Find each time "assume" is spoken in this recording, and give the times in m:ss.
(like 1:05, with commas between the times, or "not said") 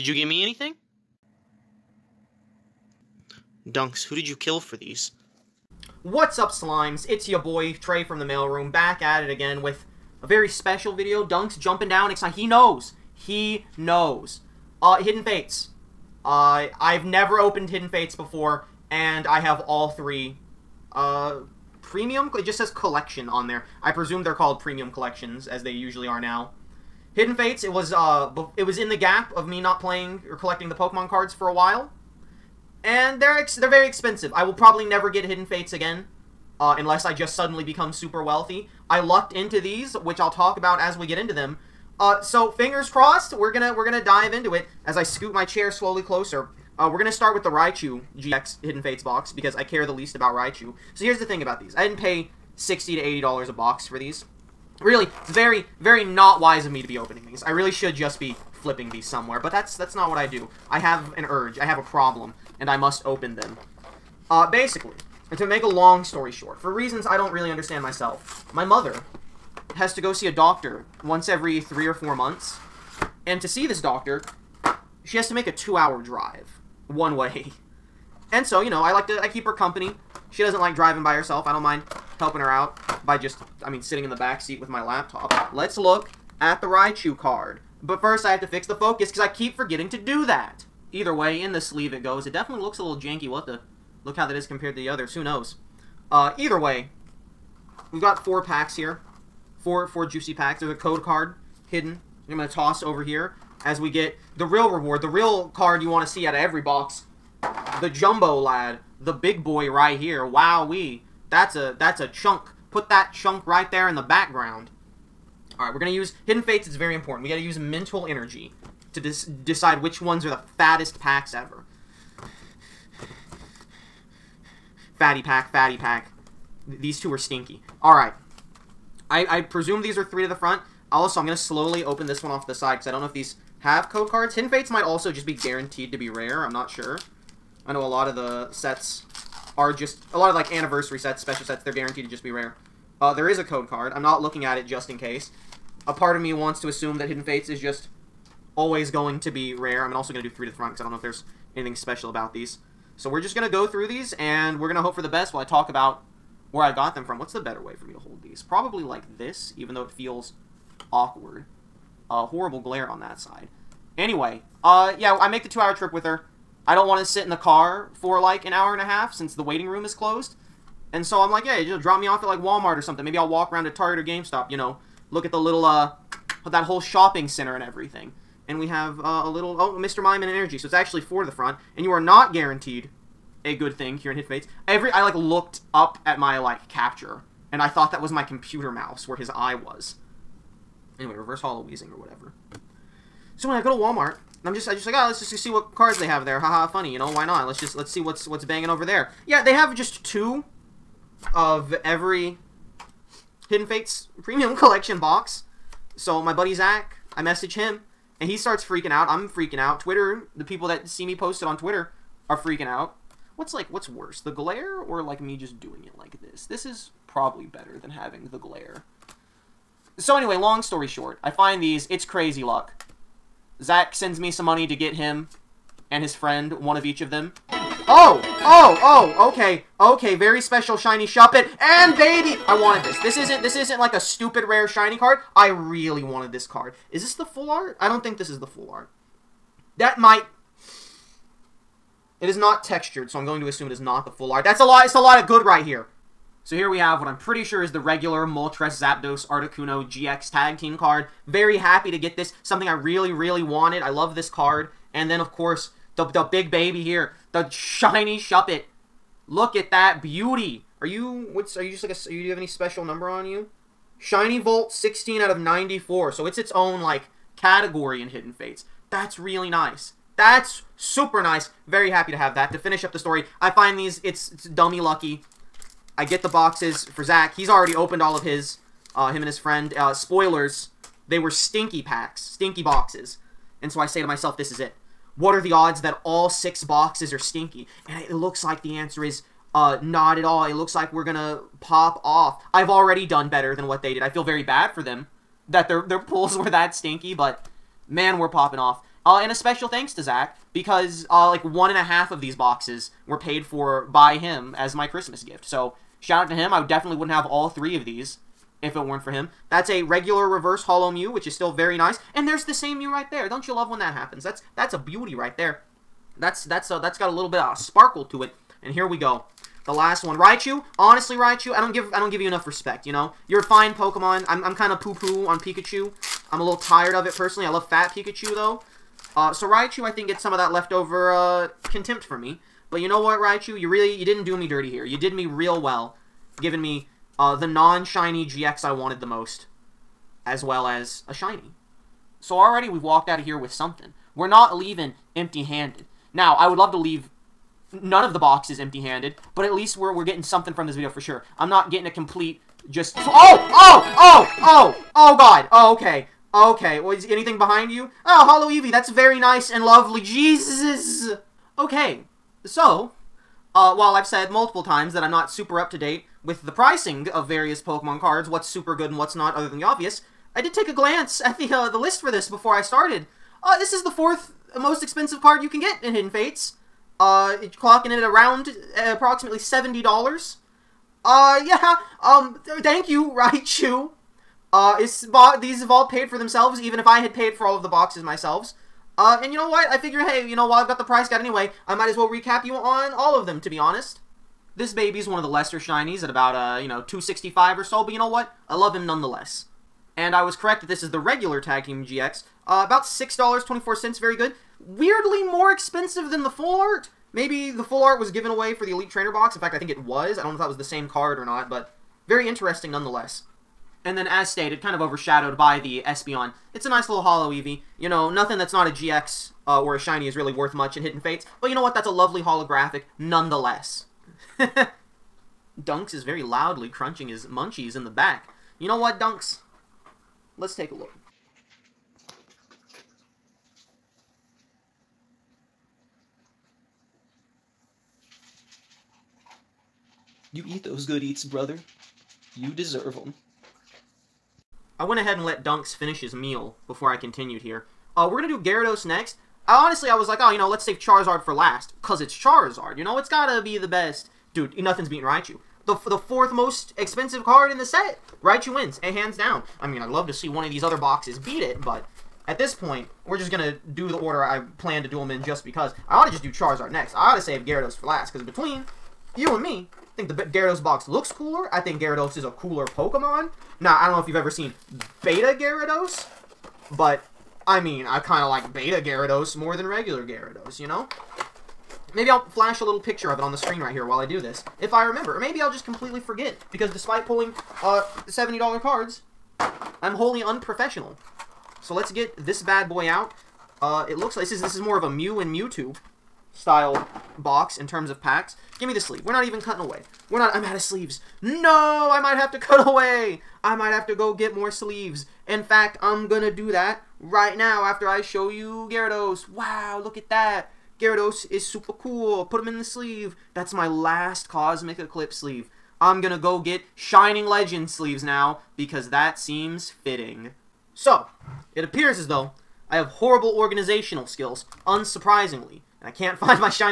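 2:26, 4:03.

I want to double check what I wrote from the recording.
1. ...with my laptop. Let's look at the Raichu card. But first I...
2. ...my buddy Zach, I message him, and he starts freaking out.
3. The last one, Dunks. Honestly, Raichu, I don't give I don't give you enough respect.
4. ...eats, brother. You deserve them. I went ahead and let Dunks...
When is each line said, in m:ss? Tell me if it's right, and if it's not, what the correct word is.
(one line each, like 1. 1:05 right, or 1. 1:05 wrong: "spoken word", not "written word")
1. 1:24 right
2. 3:26 right
3. 5:19 wrong: "Raichu", not "Dunks"
4. 7:21 right.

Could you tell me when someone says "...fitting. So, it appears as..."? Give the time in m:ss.
8:39.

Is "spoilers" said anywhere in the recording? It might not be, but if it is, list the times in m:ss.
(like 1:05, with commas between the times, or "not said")
4:39.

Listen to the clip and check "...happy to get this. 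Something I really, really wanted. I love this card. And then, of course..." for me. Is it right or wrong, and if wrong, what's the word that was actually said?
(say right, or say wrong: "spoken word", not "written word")
right.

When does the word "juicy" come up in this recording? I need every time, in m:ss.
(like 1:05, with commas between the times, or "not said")
1:40.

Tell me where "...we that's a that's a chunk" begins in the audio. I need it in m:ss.
1:50.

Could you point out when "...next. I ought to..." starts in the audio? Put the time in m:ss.
7:46.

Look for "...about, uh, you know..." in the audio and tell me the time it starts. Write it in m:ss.
6:36.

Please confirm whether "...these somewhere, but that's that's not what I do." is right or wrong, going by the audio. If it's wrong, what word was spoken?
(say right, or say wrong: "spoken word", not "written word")
right.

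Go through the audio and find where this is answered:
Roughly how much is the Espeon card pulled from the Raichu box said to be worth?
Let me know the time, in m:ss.
6:19.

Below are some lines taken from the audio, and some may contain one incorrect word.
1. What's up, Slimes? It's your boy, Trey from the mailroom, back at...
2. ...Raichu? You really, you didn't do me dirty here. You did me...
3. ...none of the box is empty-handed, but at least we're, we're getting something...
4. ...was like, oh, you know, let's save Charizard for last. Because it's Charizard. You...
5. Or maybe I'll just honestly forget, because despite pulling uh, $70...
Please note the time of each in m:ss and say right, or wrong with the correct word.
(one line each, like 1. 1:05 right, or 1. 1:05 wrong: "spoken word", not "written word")
1. 0:06 right
2. 5:33 right
3. 5:47 right
4. 7:29 right
5. 8:05 wrong: "completely", not "honestly".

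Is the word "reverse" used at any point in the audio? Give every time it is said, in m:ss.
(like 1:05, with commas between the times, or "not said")
3:11, 5:10.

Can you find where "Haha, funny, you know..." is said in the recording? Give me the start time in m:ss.
3:16.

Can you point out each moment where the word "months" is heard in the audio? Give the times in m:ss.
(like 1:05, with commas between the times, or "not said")
1:12.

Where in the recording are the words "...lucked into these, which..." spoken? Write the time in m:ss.
0:38.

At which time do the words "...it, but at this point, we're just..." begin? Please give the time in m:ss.
7:41.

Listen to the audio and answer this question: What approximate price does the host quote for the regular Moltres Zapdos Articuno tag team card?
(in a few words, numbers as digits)
$6.24.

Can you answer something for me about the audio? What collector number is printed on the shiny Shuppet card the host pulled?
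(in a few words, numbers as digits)
16 out of 94.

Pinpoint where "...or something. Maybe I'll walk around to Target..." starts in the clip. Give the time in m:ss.
2:52.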